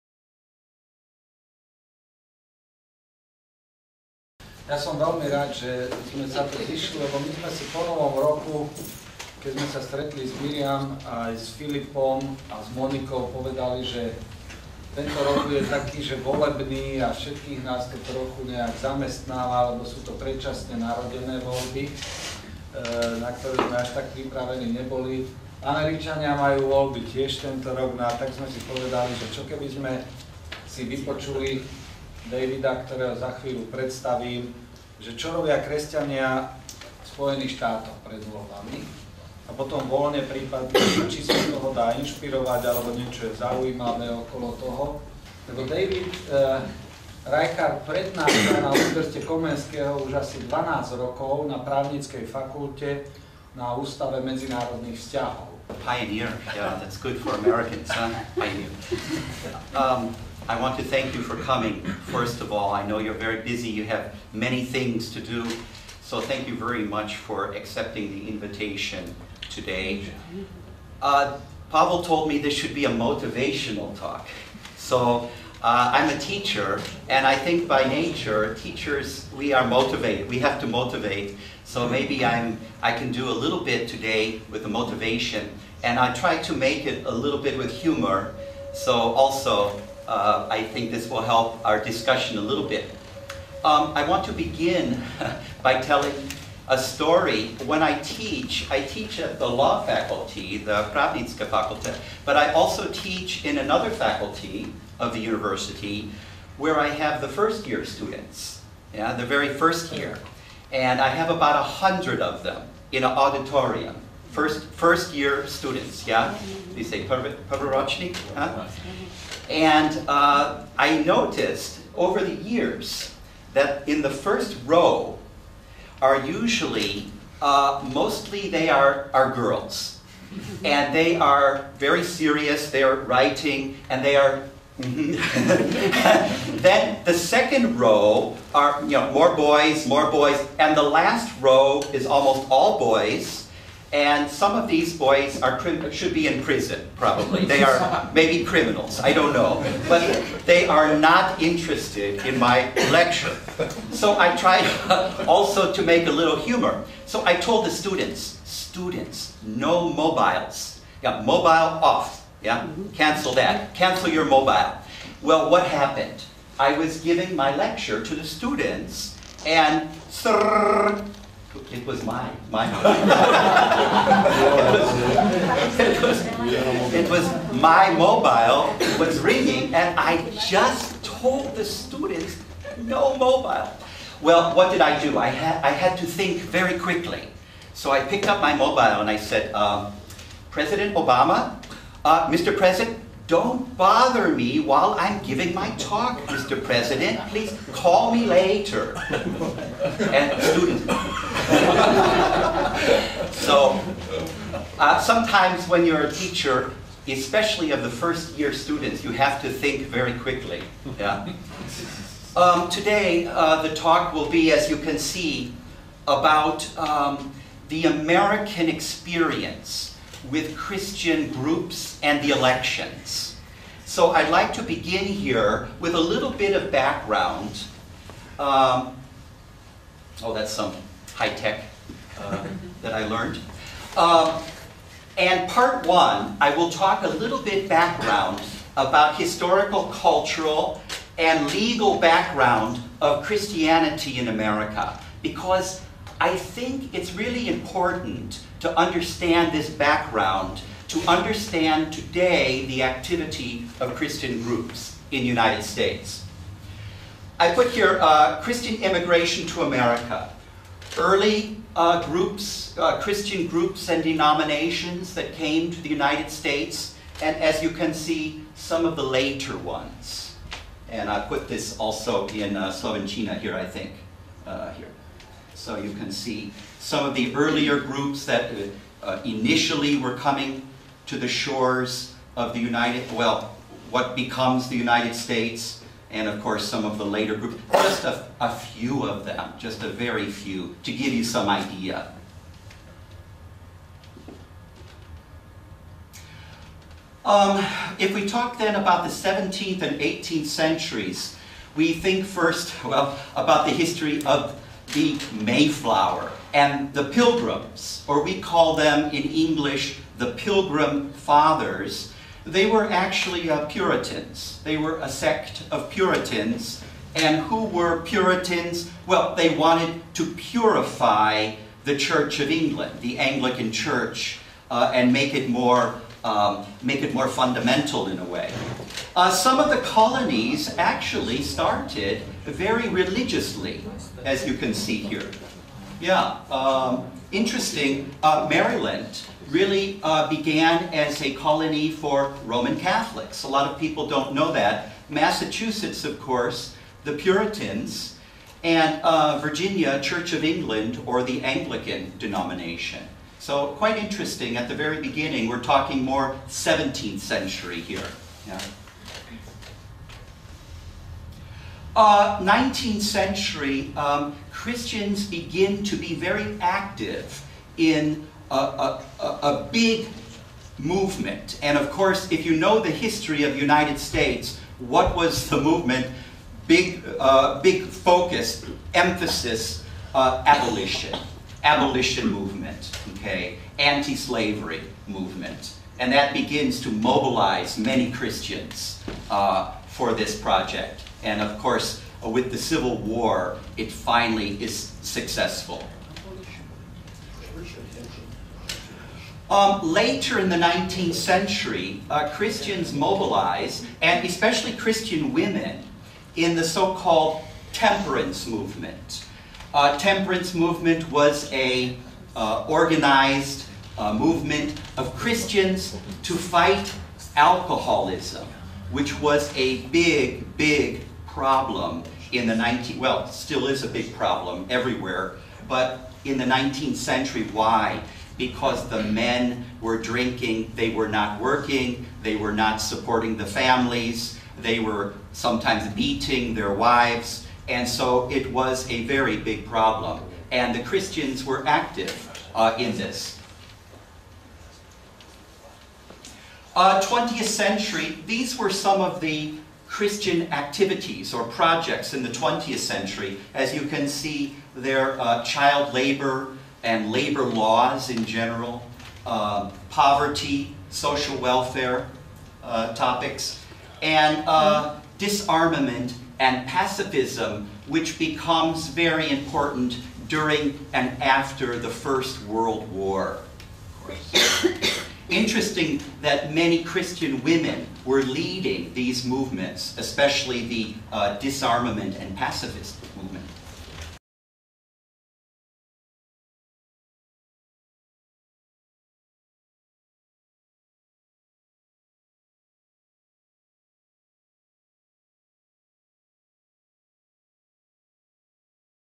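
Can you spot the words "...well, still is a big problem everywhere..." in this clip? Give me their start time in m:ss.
7:02.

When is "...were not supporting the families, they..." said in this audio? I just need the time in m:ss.
7:12.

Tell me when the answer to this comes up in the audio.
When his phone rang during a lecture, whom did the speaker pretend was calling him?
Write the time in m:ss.
3:10.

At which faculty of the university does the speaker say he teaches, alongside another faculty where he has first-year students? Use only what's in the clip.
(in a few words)
law faculty.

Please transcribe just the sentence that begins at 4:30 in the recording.
And I put this also in uh, Slovenchina here, I think, uh, here.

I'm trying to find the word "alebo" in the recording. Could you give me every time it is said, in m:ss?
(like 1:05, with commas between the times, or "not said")
0:42.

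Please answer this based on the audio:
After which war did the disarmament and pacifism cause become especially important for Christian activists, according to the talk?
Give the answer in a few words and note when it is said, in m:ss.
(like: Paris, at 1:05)
First World War, at 7:51.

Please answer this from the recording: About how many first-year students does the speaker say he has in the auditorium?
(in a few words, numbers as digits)
100.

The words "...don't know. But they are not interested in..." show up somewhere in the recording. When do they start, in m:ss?
2:29.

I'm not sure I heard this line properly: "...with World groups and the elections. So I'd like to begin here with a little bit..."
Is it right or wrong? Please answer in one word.
wrong.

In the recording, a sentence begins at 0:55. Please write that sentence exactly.
Pioneer, yeah, that's good for Americans, huh?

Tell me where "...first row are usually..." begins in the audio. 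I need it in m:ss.
2:04.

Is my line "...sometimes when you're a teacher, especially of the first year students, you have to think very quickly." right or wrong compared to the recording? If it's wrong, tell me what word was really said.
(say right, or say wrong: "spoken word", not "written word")
right.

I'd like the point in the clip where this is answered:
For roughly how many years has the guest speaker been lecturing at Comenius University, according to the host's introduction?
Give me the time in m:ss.
0:50.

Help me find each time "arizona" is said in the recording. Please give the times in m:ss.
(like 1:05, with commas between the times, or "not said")
not said.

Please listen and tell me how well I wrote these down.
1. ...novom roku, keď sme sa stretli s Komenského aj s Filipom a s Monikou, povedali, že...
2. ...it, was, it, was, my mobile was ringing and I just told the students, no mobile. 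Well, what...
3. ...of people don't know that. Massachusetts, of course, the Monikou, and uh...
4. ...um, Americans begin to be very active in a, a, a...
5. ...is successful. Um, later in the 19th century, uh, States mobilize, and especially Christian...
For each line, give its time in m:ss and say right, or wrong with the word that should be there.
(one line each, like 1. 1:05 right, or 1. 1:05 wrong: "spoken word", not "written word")
1. 0:07 wrong: "Miriam", not "Komenského"
2. 2:55 right
3. 5:43 wrong: "Puritans", not "Monikou"
4. 6:03 wrong: "Christians", not "Americans"
5. 6:34 wrong: "Christians", not "States".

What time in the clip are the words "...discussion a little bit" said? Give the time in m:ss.
1:31.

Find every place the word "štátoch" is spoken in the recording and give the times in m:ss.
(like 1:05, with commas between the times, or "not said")
0:37.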